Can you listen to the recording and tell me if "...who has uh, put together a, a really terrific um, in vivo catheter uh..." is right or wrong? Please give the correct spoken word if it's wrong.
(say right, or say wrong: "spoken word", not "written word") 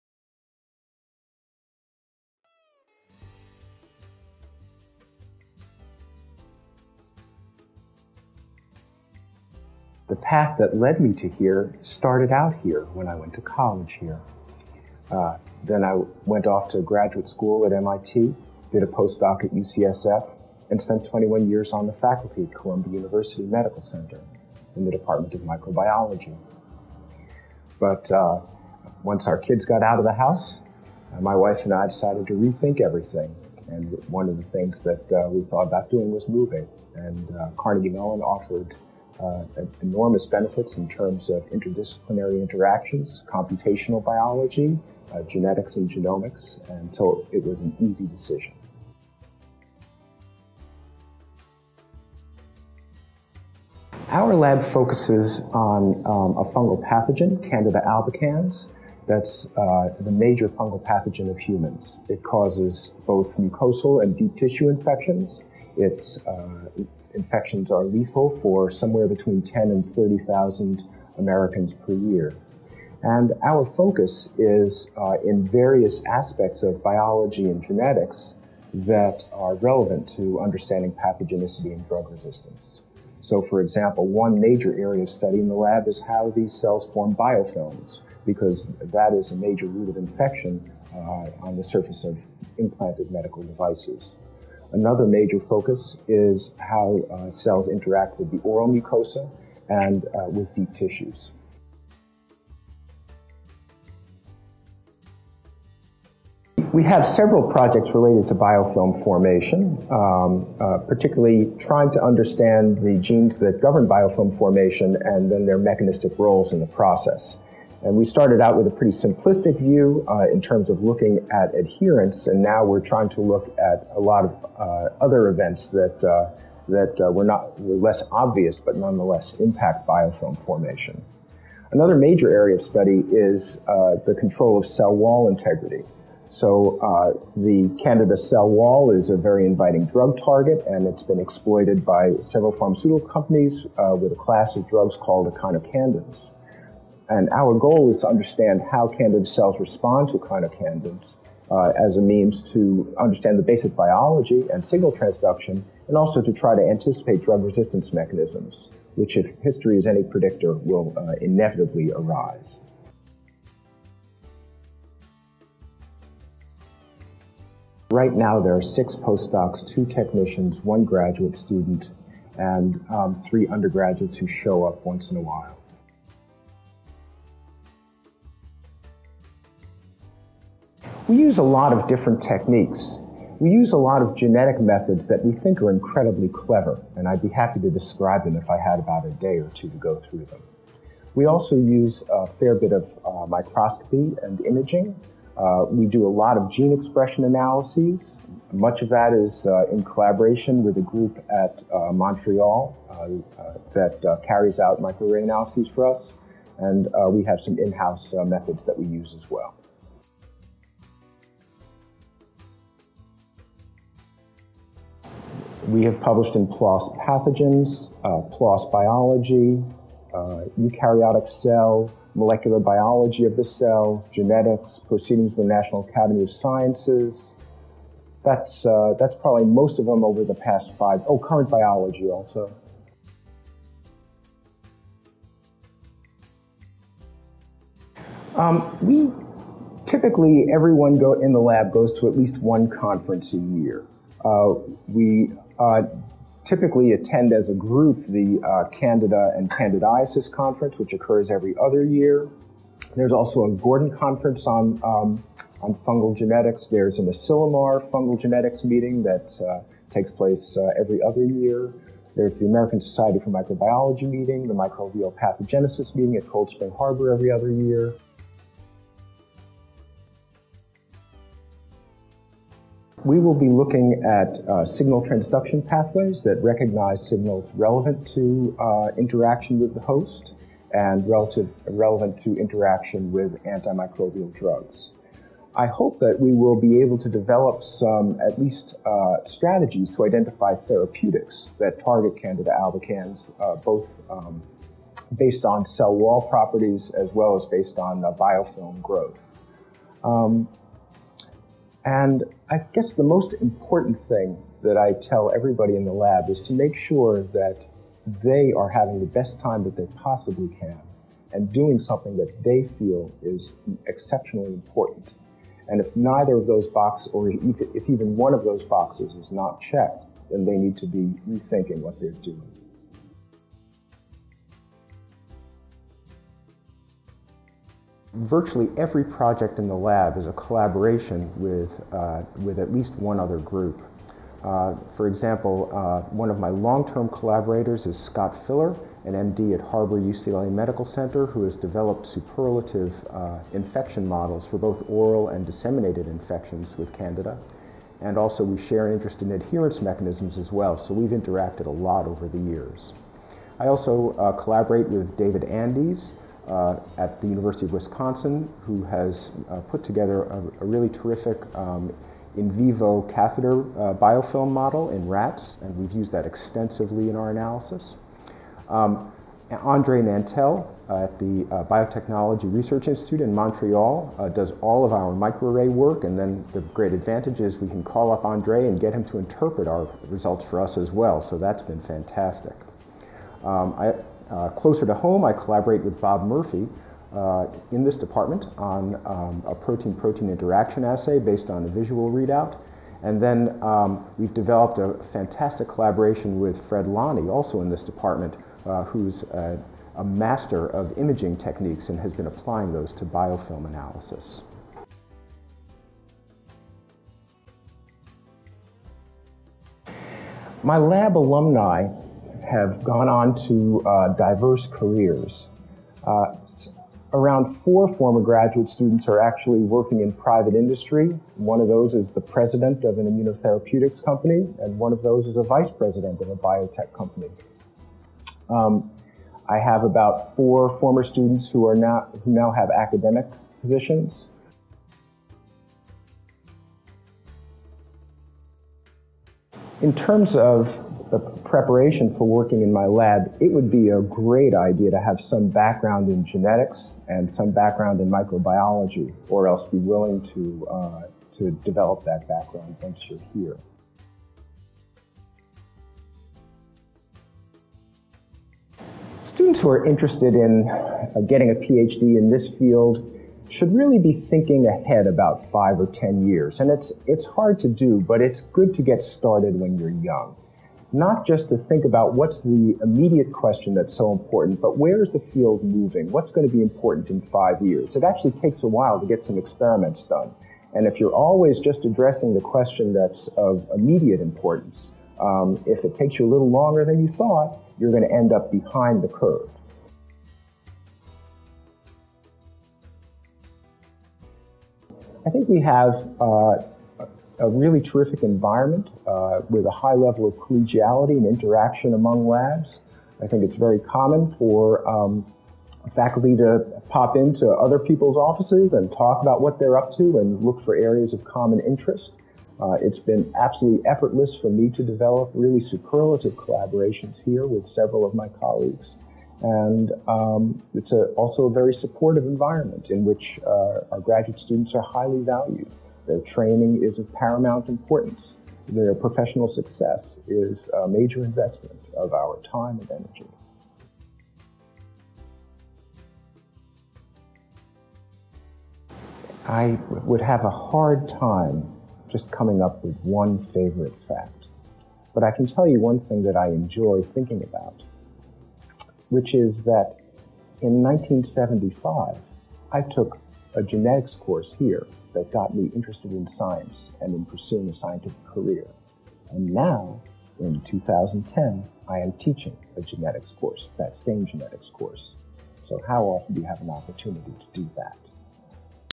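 right.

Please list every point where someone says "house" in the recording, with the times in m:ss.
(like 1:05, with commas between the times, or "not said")
0:30, 3:27.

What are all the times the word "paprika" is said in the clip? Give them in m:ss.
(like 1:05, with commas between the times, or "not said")
not said.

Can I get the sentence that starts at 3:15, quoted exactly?
Uh, we do a lot of gene expression analyses.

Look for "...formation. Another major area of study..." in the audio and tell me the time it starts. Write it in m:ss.
2:10.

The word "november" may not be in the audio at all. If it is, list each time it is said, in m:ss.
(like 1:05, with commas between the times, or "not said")
not said.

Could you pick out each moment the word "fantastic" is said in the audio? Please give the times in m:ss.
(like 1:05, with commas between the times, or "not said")
6:21, 6:35.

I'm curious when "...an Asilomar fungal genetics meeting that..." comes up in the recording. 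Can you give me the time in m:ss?
4:16.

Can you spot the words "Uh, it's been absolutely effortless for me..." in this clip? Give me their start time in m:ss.
8:32.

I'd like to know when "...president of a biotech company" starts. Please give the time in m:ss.
7:05.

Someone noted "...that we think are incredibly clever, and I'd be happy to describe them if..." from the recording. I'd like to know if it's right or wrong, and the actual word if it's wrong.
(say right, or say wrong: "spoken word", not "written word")
right.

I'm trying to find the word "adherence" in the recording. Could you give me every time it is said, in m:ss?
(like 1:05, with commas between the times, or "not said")
2:01, 5:49.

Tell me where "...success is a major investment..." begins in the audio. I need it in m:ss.
8:49.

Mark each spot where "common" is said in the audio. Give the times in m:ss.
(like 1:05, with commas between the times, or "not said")
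8:23, 8:31.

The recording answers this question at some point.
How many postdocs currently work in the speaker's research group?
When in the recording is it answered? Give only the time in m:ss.
2:48.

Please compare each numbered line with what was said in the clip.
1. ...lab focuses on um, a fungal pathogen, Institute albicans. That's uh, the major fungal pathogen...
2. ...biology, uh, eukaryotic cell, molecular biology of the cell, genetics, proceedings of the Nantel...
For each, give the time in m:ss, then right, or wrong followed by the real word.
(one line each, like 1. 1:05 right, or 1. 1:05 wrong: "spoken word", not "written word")
1. 0:54 wrong: "Candida", not "Institute"
2. 3:38 wrong: "National", not "Nantel".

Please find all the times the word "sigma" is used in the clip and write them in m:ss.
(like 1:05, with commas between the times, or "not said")
not said.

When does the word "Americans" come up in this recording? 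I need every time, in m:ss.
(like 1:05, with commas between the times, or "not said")
1:11, 4:22.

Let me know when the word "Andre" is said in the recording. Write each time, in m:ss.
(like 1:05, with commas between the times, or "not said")
6:09, 6:18.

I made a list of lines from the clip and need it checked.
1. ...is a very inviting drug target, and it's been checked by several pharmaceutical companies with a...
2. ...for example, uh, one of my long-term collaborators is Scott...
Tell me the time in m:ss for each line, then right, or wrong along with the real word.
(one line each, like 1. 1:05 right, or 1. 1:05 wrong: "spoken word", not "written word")
1. 2:18 wrong: "exploited", not "checked"
2. 5:34 right.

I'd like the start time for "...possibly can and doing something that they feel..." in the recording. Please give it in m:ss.
5:09.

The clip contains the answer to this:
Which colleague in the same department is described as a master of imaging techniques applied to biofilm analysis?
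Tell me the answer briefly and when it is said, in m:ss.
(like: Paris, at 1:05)
Fred Lanni, at 6:36.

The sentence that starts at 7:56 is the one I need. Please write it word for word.
What's going to be important in five years?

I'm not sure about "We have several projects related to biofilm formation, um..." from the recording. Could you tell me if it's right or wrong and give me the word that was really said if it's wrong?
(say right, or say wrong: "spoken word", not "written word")
right.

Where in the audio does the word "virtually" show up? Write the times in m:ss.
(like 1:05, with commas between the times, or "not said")
5:28.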